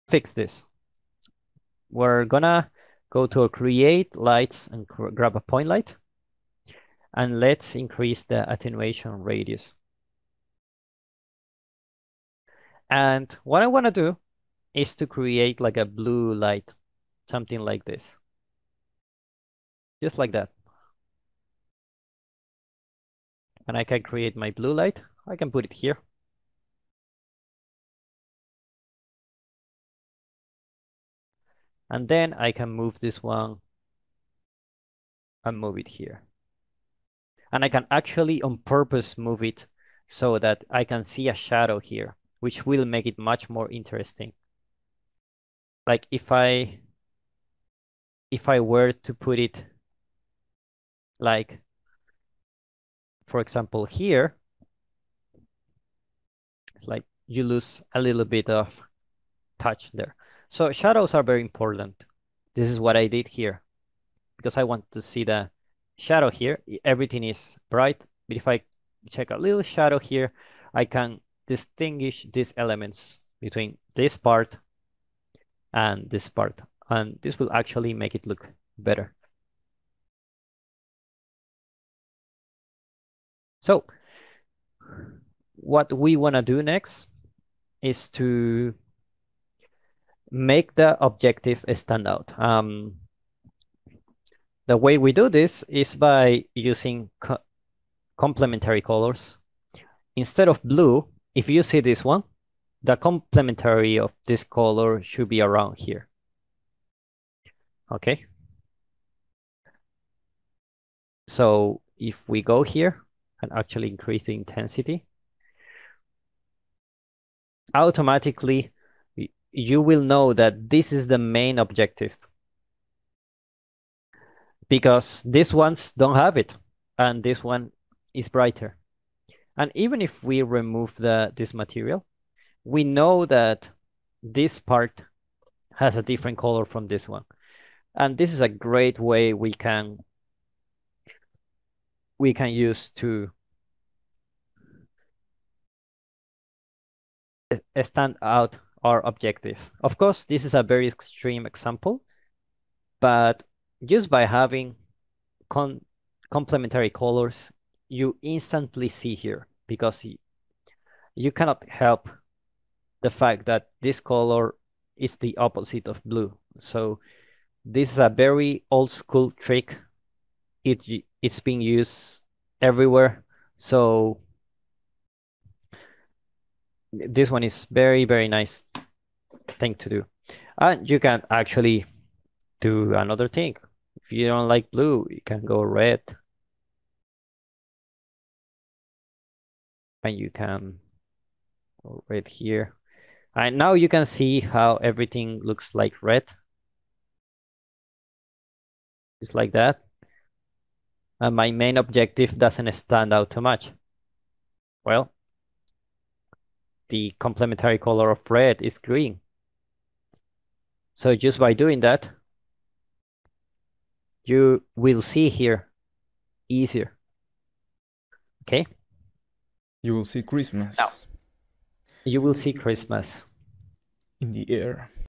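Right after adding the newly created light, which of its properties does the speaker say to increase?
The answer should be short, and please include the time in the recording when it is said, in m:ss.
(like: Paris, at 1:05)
Attenuation radius, at 0:08.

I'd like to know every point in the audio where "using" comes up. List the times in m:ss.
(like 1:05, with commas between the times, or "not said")
1:36.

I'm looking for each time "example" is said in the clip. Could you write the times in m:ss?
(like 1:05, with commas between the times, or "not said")
0:53, 2:31.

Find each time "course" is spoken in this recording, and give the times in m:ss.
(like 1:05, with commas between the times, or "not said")
2:29.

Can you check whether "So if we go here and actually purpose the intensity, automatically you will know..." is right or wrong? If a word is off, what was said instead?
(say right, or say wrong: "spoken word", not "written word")
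wrong: "increase", not "purpose".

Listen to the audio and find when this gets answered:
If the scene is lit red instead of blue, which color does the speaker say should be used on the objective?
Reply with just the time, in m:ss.
3:28.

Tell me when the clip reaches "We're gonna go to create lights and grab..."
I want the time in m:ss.
0:01.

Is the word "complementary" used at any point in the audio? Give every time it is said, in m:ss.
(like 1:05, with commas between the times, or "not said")
1:38, 1:42, 2:36, 3:27.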